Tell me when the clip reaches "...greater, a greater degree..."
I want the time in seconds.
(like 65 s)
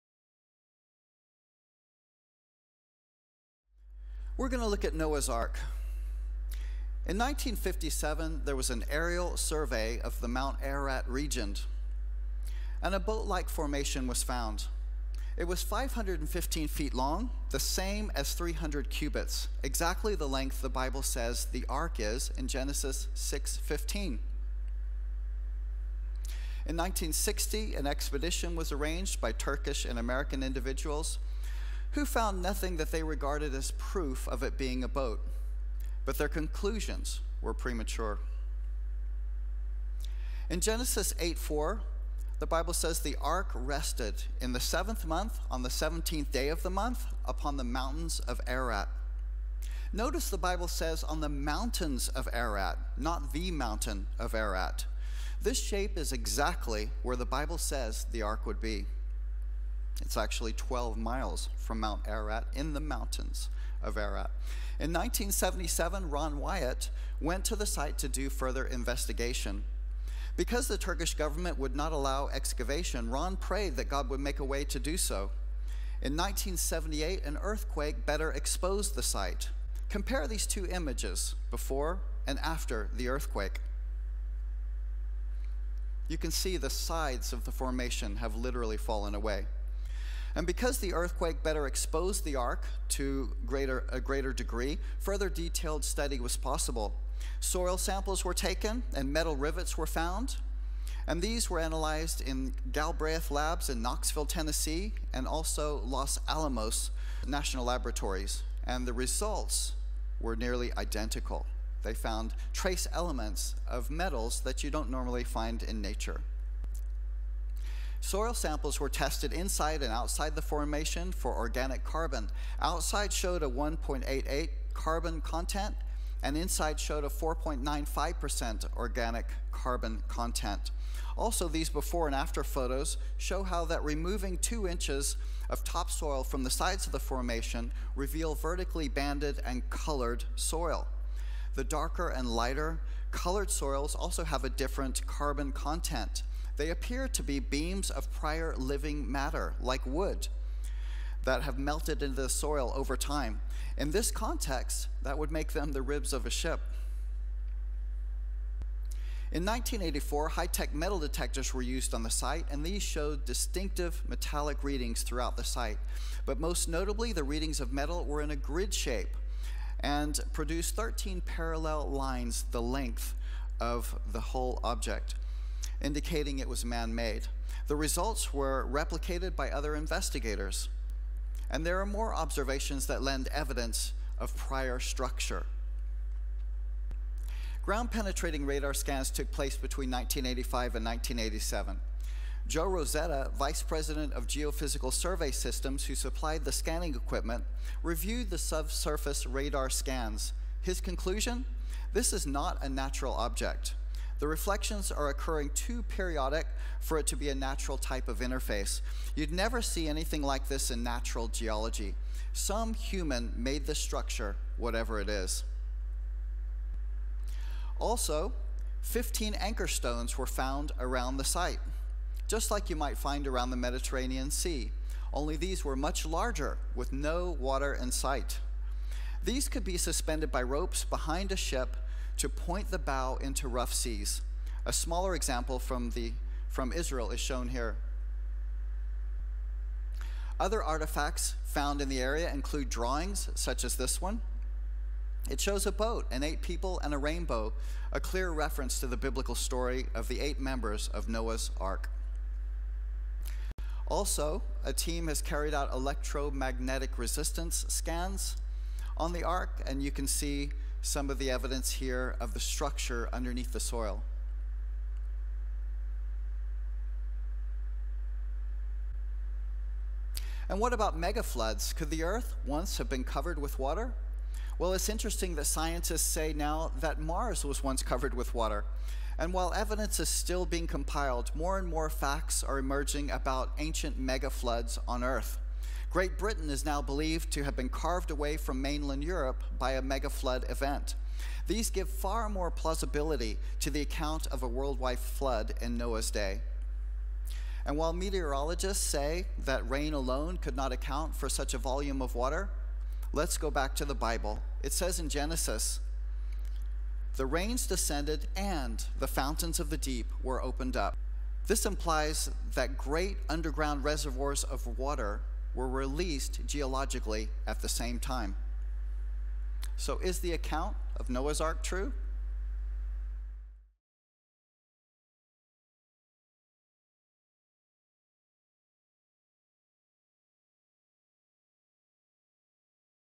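93 s.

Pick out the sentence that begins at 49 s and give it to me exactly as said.
Notice the Bible says on the mountains of Ararat, not the mountain of Ararat.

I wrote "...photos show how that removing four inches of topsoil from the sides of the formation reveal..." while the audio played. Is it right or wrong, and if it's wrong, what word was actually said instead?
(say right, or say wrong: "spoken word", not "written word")
wrong: "two", not "four".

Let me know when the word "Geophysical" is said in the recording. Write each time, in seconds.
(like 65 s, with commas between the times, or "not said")
194 s.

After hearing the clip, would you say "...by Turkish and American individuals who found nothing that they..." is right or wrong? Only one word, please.
right.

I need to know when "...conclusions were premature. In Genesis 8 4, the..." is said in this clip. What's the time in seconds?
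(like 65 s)
36 s.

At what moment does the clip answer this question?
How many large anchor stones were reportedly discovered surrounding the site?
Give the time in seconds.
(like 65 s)
218 s.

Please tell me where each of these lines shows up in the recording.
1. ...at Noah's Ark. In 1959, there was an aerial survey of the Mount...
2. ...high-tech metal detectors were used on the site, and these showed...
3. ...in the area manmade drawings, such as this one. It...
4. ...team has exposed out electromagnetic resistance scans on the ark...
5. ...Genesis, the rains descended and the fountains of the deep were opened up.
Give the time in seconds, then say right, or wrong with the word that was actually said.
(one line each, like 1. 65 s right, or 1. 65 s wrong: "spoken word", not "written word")
1. 4 s wrong: "1957", not "1959"
2. 160 s right
3. 241 s wrong: "include", not "manmade"
4. 254 s wrong: "carried", not "exposed"
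5. 305 s right.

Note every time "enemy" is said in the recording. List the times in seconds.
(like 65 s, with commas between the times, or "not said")
not said.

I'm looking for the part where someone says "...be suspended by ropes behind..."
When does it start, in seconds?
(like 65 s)
229 s.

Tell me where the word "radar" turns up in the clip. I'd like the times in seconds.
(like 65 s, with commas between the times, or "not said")
188 s, 199 s.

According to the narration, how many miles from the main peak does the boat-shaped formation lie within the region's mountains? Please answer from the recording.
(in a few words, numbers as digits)
12 miles.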